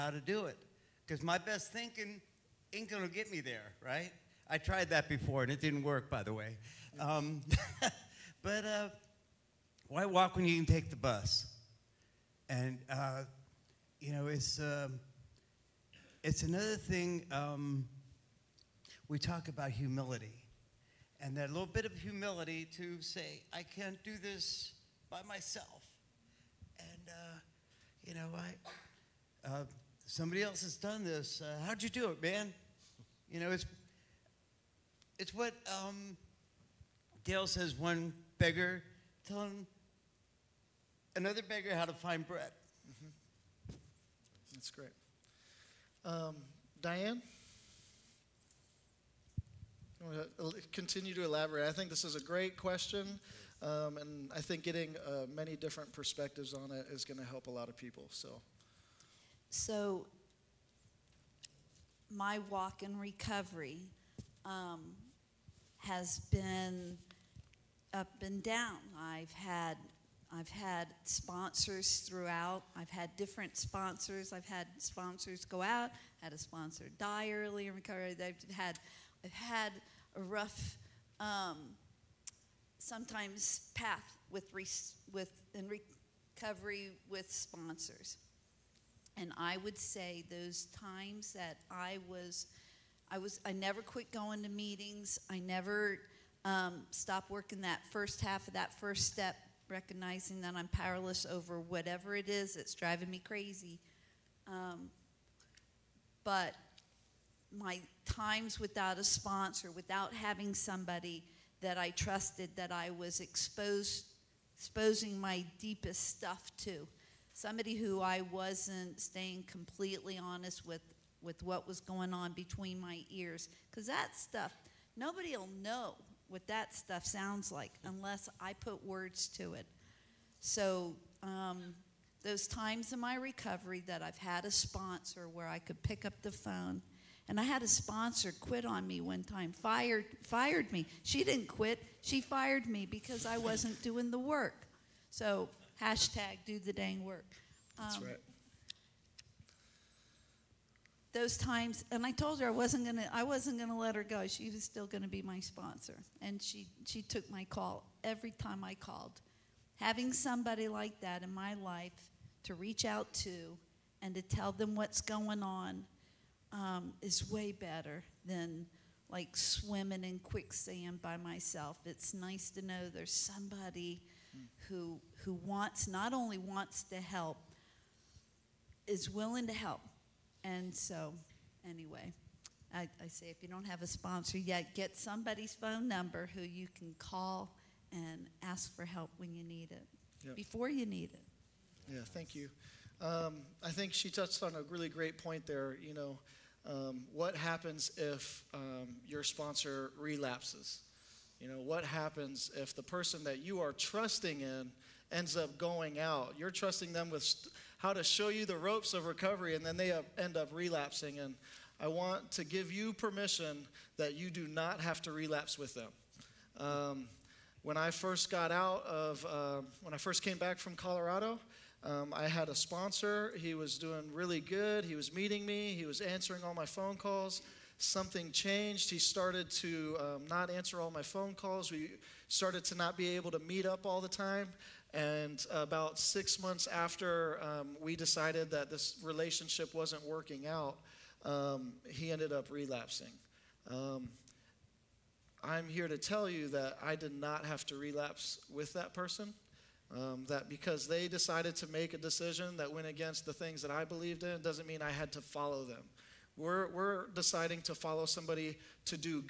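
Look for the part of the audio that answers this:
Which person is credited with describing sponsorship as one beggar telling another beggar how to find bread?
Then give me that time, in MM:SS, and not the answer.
00:37.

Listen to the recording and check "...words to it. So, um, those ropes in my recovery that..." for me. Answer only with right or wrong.
wrong.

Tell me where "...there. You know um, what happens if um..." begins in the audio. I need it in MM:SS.
03:15.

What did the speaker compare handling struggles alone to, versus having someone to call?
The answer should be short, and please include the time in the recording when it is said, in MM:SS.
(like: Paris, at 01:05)
Swimming in quicksand, at 02:49.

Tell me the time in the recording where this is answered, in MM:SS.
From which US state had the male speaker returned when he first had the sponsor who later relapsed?
03:40.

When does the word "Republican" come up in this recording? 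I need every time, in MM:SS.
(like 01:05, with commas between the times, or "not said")
not said.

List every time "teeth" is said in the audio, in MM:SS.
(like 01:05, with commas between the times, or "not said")
not said.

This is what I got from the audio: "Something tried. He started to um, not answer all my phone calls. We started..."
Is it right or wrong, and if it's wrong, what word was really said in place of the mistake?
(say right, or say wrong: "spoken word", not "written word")
wrong: "changed", not "tried".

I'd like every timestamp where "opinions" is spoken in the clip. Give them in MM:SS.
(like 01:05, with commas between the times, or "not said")
not said.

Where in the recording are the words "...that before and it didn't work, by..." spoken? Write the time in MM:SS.
00:04.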